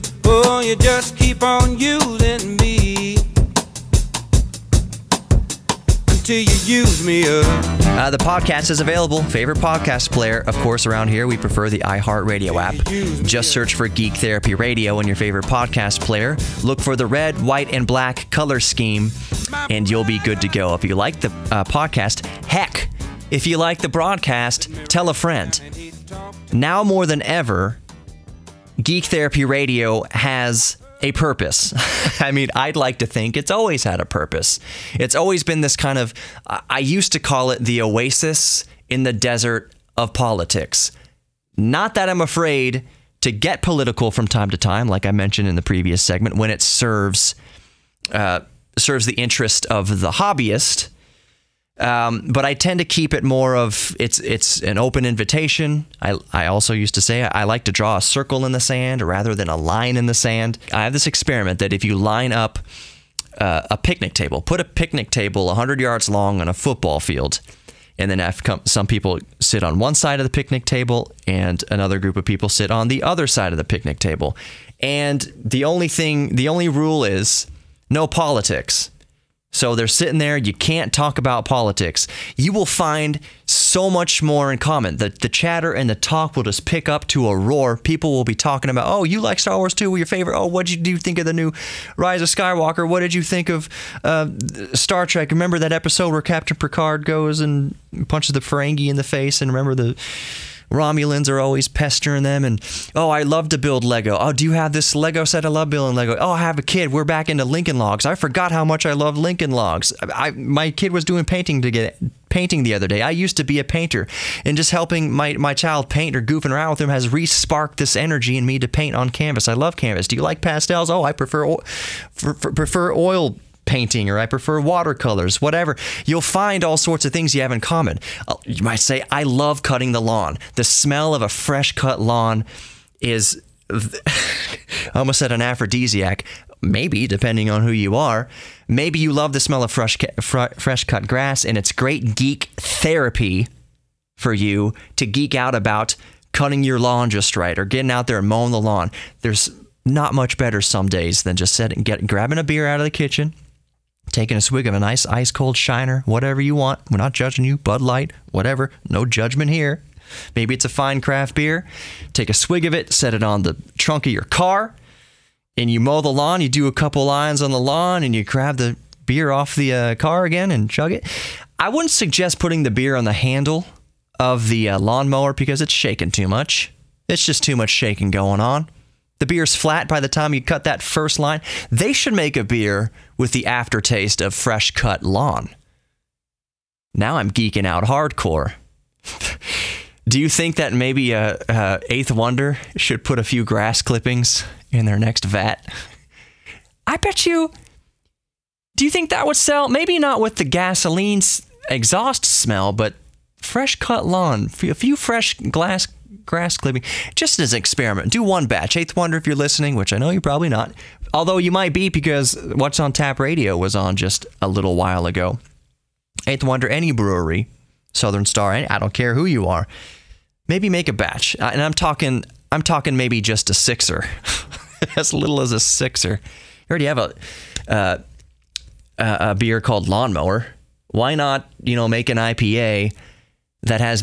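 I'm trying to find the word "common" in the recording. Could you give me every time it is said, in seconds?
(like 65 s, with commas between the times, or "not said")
84 s, 127 s.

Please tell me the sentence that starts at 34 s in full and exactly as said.
It's always been this kind of, I used to call it the oasis in the desert of politics.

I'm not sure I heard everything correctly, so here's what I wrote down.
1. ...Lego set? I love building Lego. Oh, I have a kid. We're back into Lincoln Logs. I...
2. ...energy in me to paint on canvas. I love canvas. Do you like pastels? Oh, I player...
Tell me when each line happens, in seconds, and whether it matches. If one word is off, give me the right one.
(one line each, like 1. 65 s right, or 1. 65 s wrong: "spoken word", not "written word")
1. 104 s right
2. 117 s wrong: "prefer", not "player".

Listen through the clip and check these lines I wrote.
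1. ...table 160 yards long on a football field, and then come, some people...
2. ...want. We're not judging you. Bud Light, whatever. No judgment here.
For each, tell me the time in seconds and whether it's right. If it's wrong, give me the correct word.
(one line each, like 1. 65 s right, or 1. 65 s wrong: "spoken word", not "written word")
1. 65 s wrong: "100", not "160"
2. 156 s right.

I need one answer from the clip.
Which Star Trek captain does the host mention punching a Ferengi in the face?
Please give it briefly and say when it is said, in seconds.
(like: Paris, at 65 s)
Picard, at 96 s.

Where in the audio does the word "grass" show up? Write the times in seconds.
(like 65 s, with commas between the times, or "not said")
141 s, 193 s, 206 s.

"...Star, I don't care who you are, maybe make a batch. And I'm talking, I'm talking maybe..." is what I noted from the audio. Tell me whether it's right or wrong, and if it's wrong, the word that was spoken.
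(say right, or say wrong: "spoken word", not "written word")
right.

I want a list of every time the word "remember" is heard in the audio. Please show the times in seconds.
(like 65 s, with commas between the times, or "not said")
95 s, 99 s.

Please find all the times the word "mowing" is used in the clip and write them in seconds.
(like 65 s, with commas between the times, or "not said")
148 s.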